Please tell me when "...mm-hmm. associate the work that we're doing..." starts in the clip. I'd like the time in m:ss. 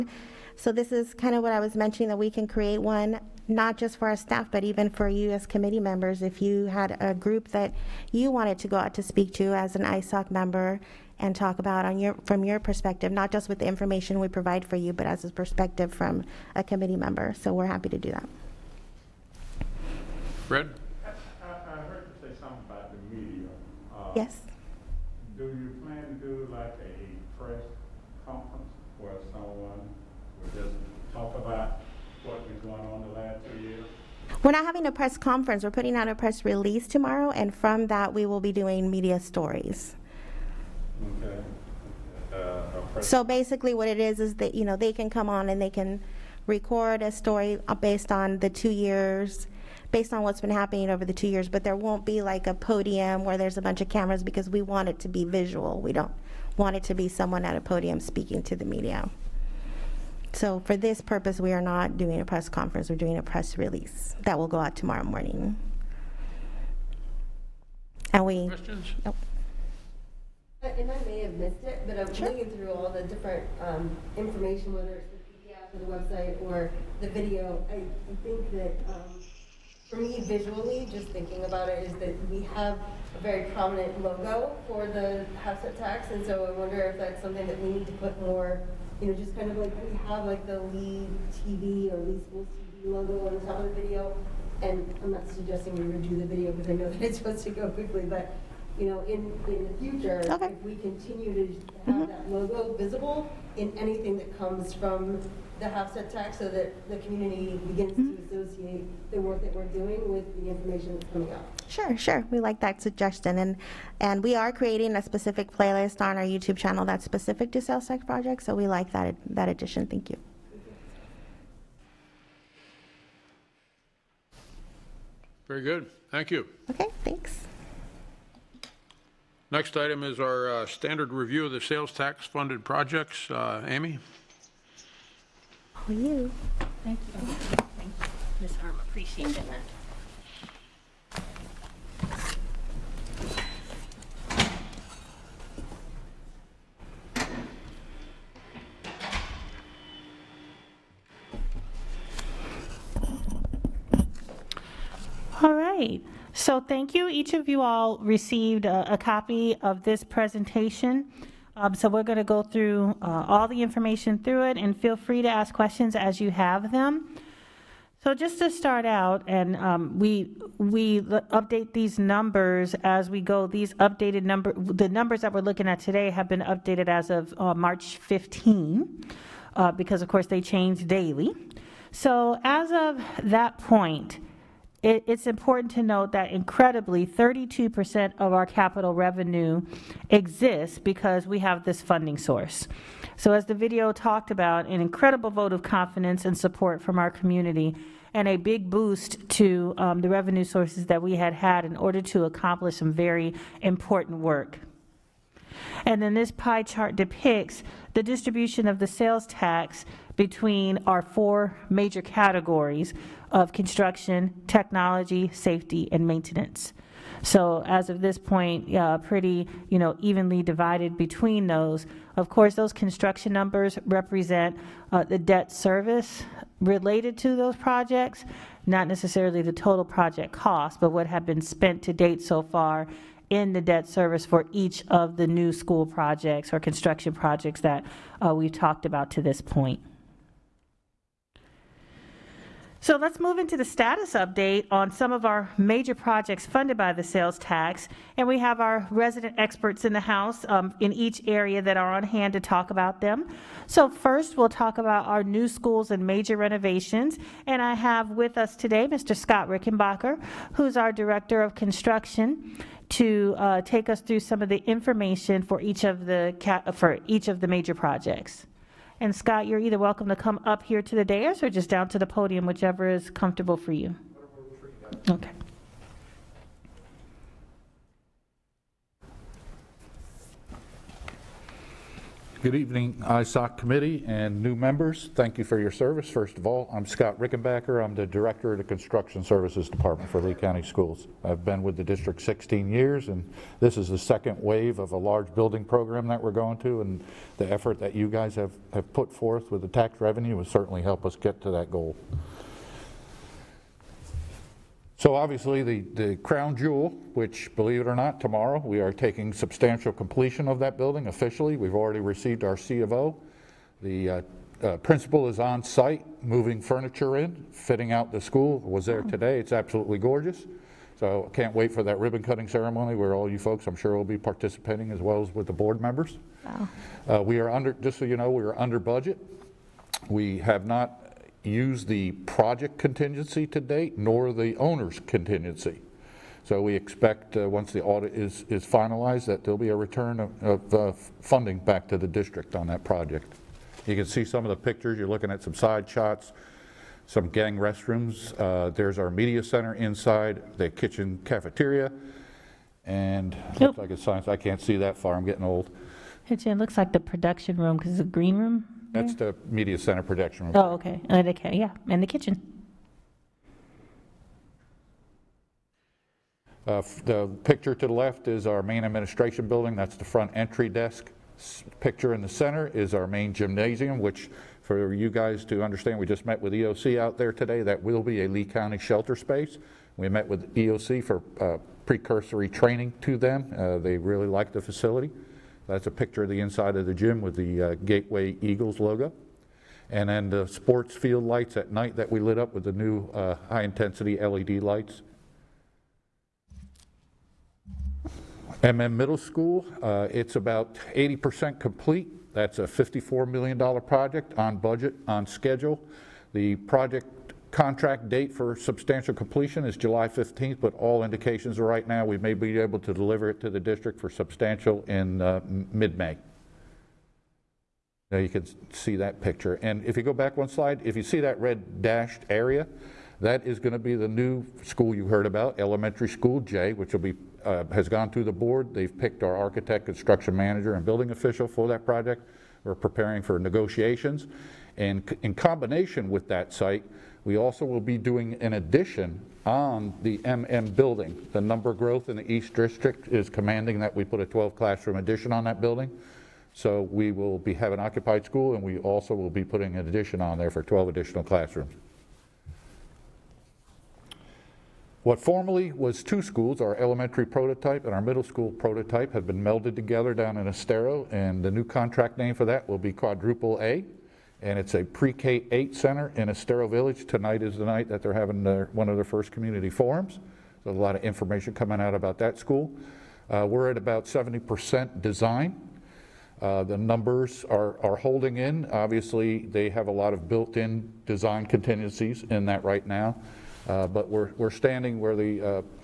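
1:48.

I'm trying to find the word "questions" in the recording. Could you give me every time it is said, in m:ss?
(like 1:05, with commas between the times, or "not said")
1:08, 2:45.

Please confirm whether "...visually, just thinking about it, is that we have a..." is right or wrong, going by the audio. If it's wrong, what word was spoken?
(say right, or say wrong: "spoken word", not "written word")
right.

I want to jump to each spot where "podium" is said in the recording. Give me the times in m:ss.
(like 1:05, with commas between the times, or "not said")
0:52, 0:57, 4:32.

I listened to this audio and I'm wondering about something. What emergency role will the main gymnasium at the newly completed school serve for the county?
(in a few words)
Shelter space.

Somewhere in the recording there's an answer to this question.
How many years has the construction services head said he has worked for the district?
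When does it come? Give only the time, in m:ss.
4:52.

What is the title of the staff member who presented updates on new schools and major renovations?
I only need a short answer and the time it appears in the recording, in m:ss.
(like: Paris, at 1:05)
Director of Construction, at 4:20.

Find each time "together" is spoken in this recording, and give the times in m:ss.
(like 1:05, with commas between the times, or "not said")
7:39.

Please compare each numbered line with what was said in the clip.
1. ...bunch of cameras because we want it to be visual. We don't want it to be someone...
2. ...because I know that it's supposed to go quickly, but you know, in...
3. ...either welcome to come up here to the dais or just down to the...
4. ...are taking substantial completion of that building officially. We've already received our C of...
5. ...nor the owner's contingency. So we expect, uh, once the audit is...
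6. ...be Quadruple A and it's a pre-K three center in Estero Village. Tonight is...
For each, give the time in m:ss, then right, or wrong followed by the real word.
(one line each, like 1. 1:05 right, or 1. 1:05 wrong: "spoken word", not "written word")
1. 0:53 right
2. 1:36 right
3. 4:29 right
4. 5:08 right
5. 5:33 right
6. 7:42 wrong: "eight", not "three".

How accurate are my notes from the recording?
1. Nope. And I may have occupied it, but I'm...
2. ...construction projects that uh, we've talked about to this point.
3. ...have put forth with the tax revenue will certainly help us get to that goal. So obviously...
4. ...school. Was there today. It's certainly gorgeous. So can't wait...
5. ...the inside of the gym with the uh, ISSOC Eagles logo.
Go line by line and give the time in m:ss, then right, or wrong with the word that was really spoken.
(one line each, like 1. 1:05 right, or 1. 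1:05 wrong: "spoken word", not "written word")
1. 1:09 wrong: "missed", not "occupied"
2. 3:56 right
3. 4:58 right
4. 5:18 wrong: "absolutely", not "certainly"
5. 6:26 wrong: "Gateway", not "ISSOC".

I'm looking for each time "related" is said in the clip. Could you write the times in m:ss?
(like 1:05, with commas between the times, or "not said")
3:46.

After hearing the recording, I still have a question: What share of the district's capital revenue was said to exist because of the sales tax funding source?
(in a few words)
32%.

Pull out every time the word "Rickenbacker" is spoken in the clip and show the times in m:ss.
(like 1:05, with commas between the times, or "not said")
4:19, 4:47.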